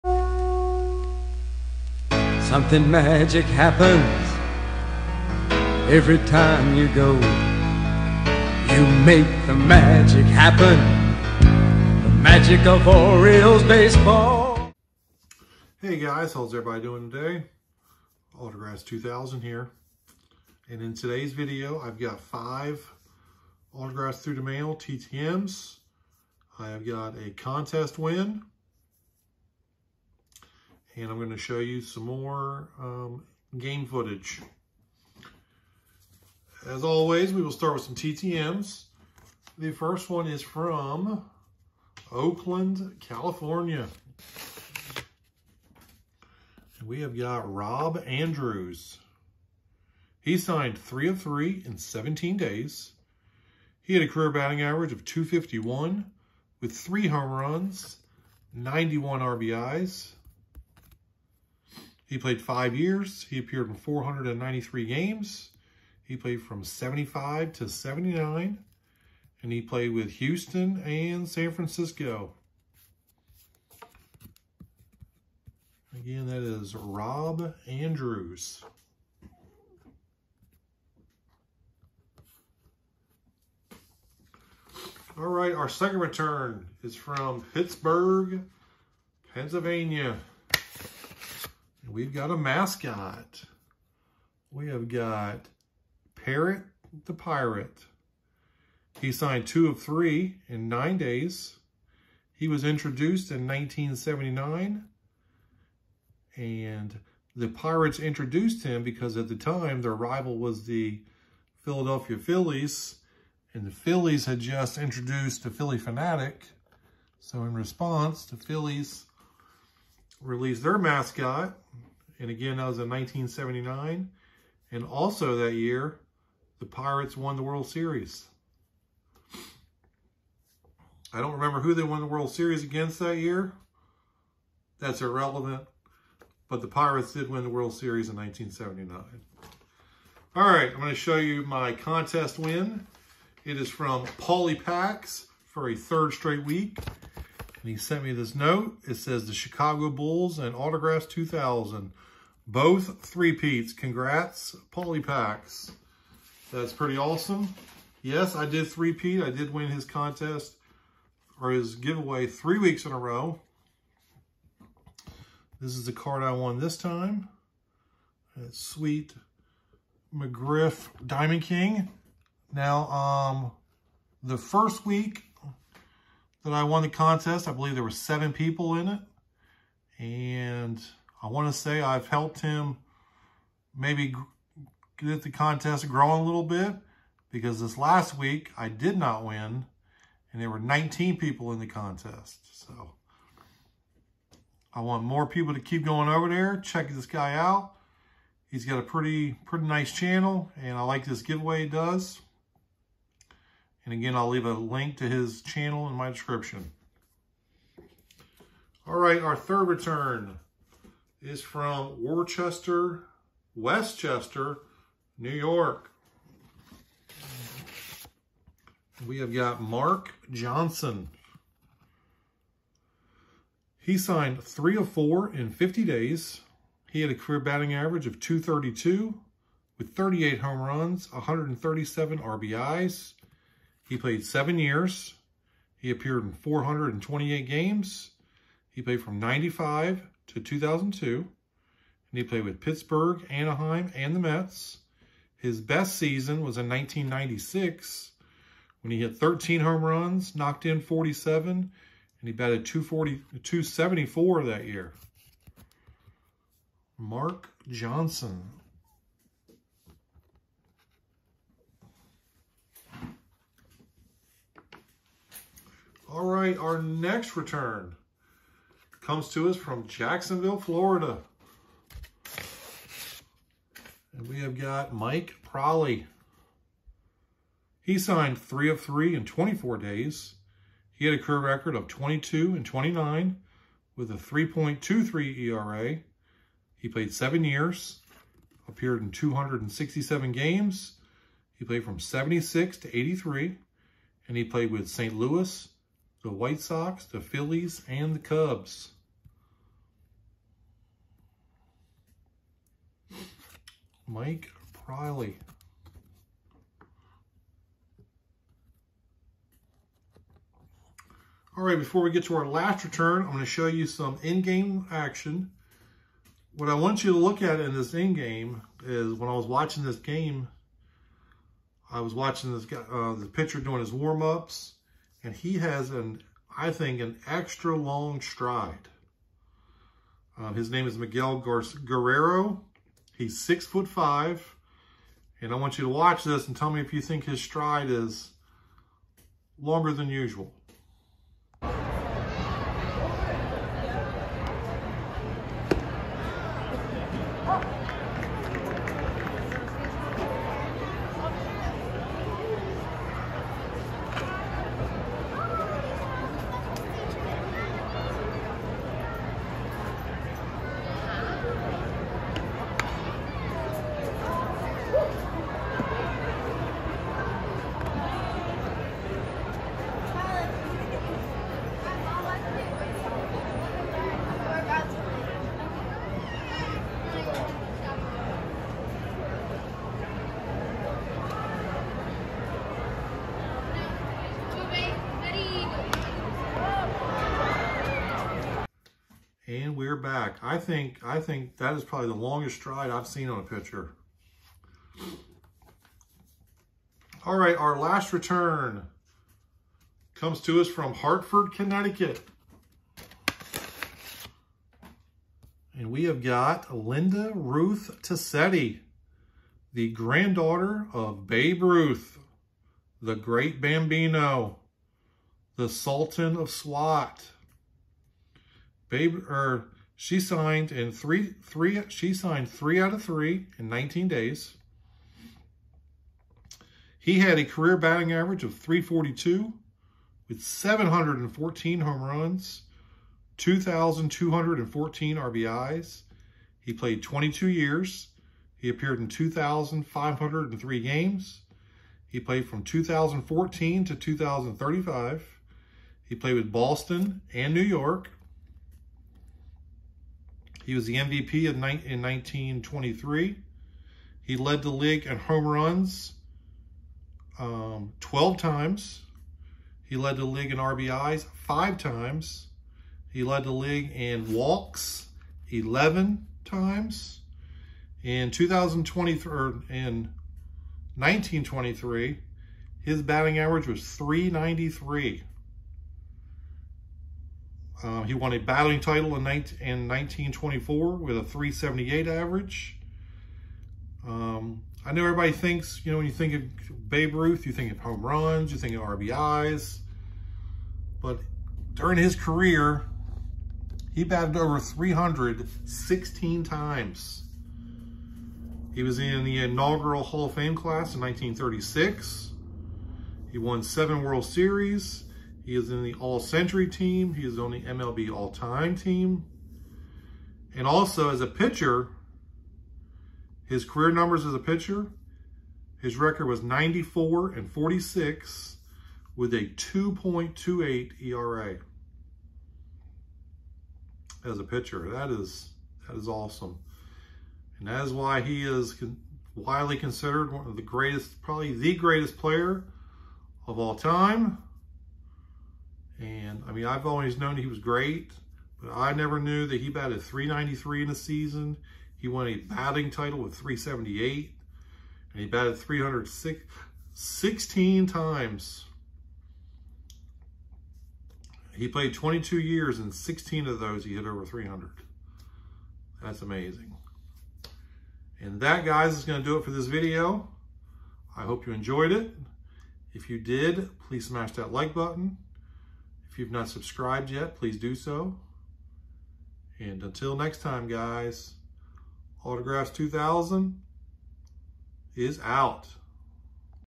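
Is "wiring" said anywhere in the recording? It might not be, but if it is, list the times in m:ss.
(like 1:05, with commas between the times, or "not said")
not said.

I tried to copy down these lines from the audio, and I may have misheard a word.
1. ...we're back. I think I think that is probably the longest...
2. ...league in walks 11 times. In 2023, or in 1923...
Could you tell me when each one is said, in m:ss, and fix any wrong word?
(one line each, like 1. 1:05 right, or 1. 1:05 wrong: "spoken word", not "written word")
1. 6:29 right
2. 7:43 right.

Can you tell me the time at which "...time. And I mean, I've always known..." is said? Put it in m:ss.
8:53.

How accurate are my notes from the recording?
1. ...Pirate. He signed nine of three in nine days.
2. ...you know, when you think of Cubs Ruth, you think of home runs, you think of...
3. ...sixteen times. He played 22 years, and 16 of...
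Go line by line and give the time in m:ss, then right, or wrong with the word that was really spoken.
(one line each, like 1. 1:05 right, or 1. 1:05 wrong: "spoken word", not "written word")
1. 1:37 wrong: "two", not "nine"
2. 8:05 wrong: "Babe", not "Cubs"
3. 9:06 right.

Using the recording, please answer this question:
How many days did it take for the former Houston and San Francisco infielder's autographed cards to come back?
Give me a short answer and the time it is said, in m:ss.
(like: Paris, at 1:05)
17, at 0:51.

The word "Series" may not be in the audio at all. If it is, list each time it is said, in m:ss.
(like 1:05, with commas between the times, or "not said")
2:07, 2:12, 2:17, 8:24.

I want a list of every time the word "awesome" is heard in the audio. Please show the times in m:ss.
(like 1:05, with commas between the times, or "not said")
2:36, 8:46.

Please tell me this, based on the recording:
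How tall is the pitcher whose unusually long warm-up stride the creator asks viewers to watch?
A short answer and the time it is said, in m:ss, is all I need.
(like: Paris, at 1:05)
6 foot 5, at 5:33.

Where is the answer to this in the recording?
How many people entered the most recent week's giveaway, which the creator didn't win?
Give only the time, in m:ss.
3:10.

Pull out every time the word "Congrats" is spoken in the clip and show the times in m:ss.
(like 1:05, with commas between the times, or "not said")
2:33.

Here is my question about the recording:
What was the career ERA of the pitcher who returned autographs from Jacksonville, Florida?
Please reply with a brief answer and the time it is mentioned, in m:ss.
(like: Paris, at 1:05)
3.23, at 4:44.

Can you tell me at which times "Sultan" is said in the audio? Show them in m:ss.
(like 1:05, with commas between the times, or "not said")
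6:55.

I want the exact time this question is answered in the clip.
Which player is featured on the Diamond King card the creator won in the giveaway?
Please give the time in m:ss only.
2:50.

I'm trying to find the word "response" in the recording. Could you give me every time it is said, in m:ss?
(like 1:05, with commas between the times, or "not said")
1:57.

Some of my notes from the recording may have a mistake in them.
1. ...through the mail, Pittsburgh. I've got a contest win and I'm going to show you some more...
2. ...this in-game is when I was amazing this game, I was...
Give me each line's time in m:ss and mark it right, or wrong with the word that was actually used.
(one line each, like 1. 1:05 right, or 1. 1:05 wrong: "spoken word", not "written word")
1. 0:24 wrong: "TTMs", not "Pittsburgh"
2. 5:17 wrong: "watching", not "amazing".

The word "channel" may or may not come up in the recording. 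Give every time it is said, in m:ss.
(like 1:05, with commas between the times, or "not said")
3:19, 3:25.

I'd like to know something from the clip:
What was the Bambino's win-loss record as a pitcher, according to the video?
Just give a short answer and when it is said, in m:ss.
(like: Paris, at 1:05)
94 and 46, at 8:36.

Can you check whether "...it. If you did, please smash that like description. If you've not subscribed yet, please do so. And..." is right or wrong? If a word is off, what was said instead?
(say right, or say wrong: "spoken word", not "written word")
wrong: "button", not "description".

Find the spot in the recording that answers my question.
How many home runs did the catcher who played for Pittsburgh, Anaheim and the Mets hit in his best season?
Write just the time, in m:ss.
4:09.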